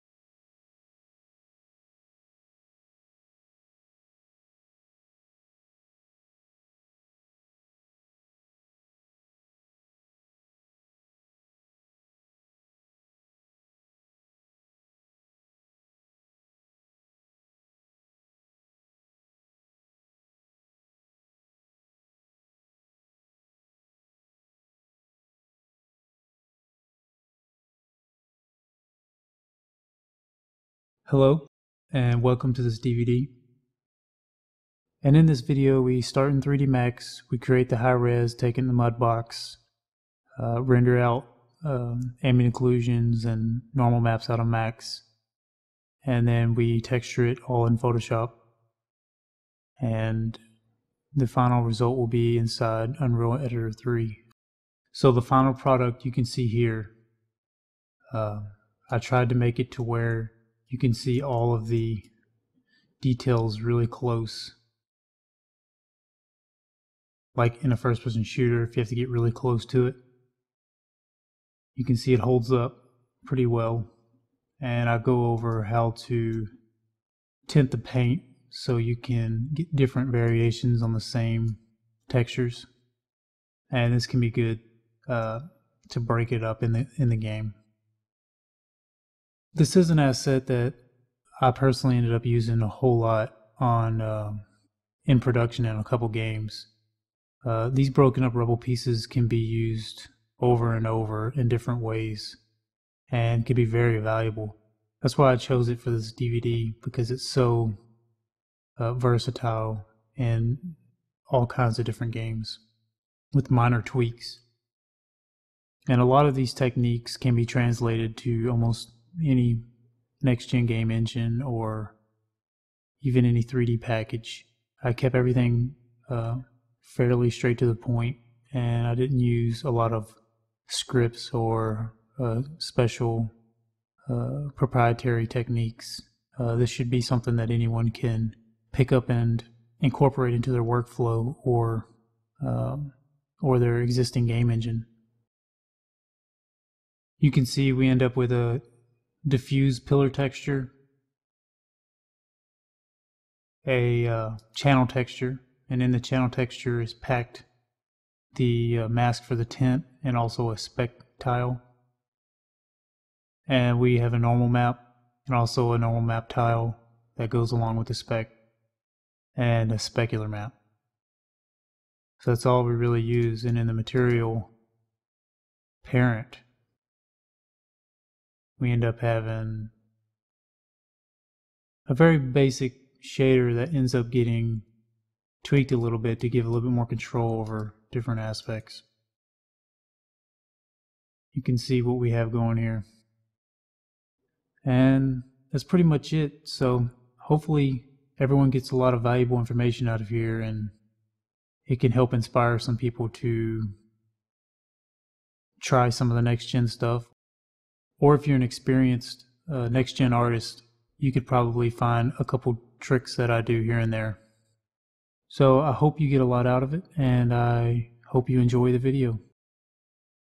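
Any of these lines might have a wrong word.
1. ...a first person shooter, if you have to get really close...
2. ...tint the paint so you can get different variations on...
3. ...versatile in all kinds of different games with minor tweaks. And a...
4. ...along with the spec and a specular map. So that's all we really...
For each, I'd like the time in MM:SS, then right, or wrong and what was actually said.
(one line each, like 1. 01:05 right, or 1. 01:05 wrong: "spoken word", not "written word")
1. 01:07 right
2. 01:17 right
3. 01:48 right
4. 02:47 right.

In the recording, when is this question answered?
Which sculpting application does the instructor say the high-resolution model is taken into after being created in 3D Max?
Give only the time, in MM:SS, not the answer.
00:38.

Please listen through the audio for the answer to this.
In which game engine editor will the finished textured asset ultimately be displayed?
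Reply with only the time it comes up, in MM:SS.
00:52.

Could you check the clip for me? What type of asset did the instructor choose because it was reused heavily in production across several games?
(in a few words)
Broken up rubble pieces.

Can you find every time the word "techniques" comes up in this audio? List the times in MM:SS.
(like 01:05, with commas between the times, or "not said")
01:56, 02:15.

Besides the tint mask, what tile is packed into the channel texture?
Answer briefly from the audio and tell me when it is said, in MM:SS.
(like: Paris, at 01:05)
Spec tile, at 02:40.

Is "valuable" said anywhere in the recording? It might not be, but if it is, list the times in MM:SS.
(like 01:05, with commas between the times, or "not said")
01:43, 03:19.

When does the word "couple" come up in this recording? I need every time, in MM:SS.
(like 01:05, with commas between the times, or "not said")
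01:35, 03:32.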